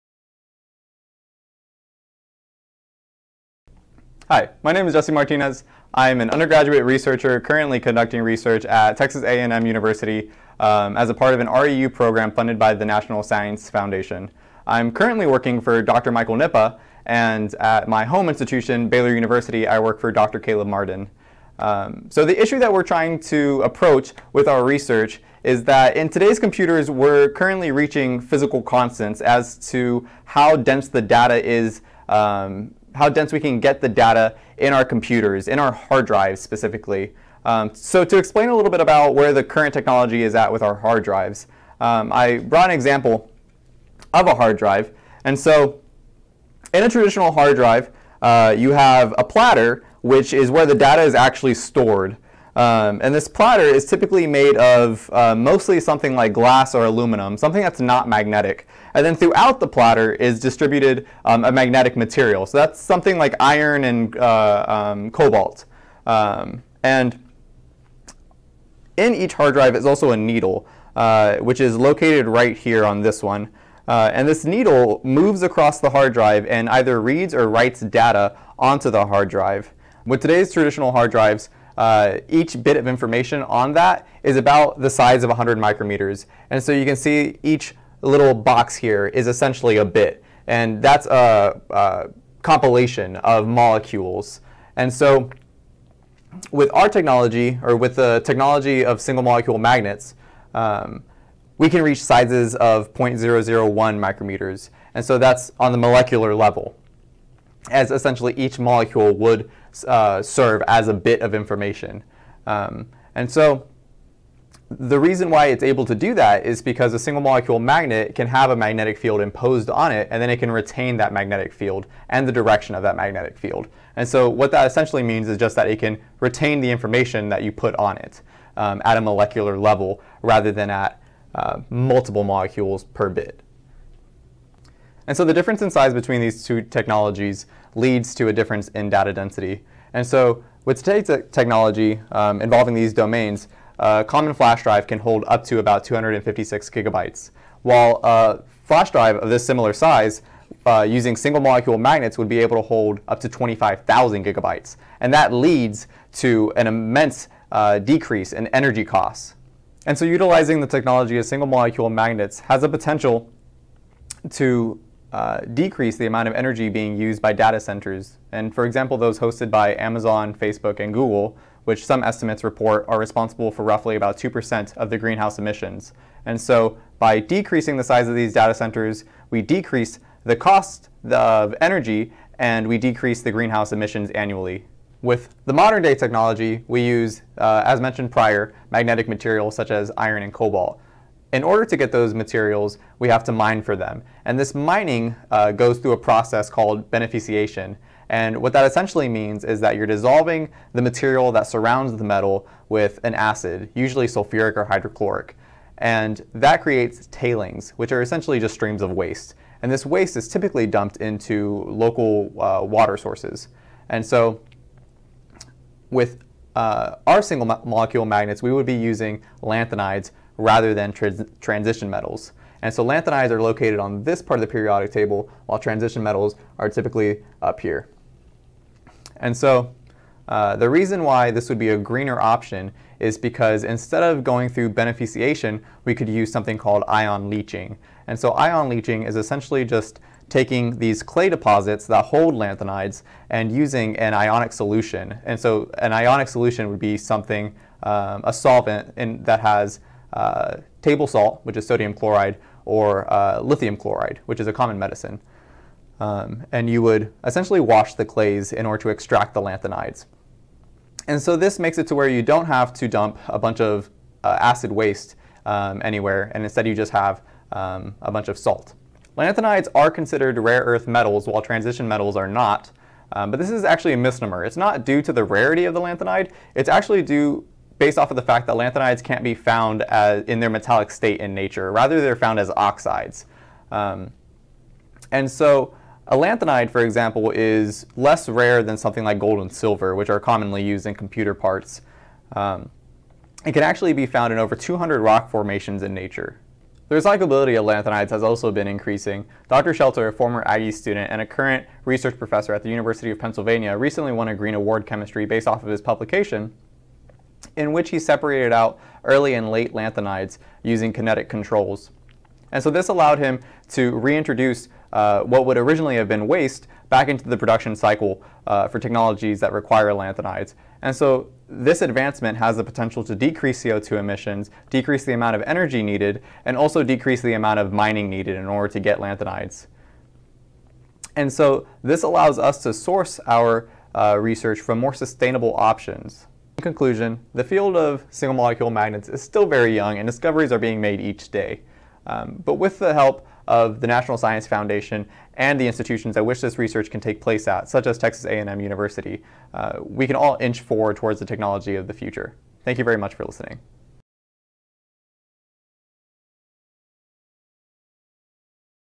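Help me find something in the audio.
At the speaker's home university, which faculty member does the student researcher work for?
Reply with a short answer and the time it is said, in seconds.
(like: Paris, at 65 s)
Dr. Caleb Martin, at 20 s.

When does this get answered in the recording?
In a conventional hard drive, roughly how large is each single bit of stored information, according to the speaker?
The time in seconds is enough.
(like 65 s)
85 s.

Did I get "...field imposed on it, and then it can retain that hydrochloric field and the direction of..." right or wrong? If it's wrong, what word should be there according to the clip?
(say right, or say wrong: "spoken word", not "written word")
wrong: "magnetic", not "hydrochloric".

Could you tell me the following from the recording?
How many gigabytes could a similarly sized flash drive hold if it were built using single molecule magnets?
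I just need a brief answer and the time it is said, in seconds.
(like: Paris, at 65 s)
25,000 gigabytes, at 153 s.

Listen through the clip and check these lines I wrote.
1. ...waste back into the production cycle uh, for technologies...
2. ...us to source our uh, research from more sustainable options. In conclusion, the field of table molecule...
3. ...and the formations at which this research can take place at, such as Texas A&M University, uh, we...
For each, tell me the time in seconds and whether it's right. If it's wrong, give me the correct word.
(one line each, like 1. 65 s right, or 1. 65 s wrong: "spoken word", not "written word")
1. 316 s right
2. 332 s wrong: "single", not "table"
3. 345 s wrong: "institutions", not "formations".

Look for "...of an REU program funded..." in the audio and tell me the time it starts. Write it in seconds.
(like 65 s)
11 s.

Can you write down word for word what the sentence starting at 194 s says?
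And this mining uh, goes through a process called beneficiation.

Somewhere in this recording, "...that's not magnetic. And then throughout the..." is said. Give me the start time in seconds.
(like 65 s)
57 s.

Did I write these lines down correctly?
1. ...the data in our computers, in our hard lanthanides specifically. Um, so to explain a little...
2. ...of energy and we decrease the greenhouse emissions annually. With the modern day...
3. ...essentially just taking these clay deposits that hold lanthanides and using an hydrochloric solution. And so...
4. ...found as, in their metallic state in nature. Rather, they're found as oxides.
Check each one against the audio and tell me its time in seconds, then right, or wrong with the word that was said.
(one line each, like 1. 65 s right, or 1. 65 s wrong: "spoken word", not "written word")
1. 33 s wrong: "drives", not "lanthanides"
2. 181 s right
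3. 239 s wrong: "ionic", not "hydrochloric"
4. 279 s right.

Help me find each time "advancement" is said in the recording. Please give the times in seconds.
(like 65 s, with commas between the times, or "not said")
321 s.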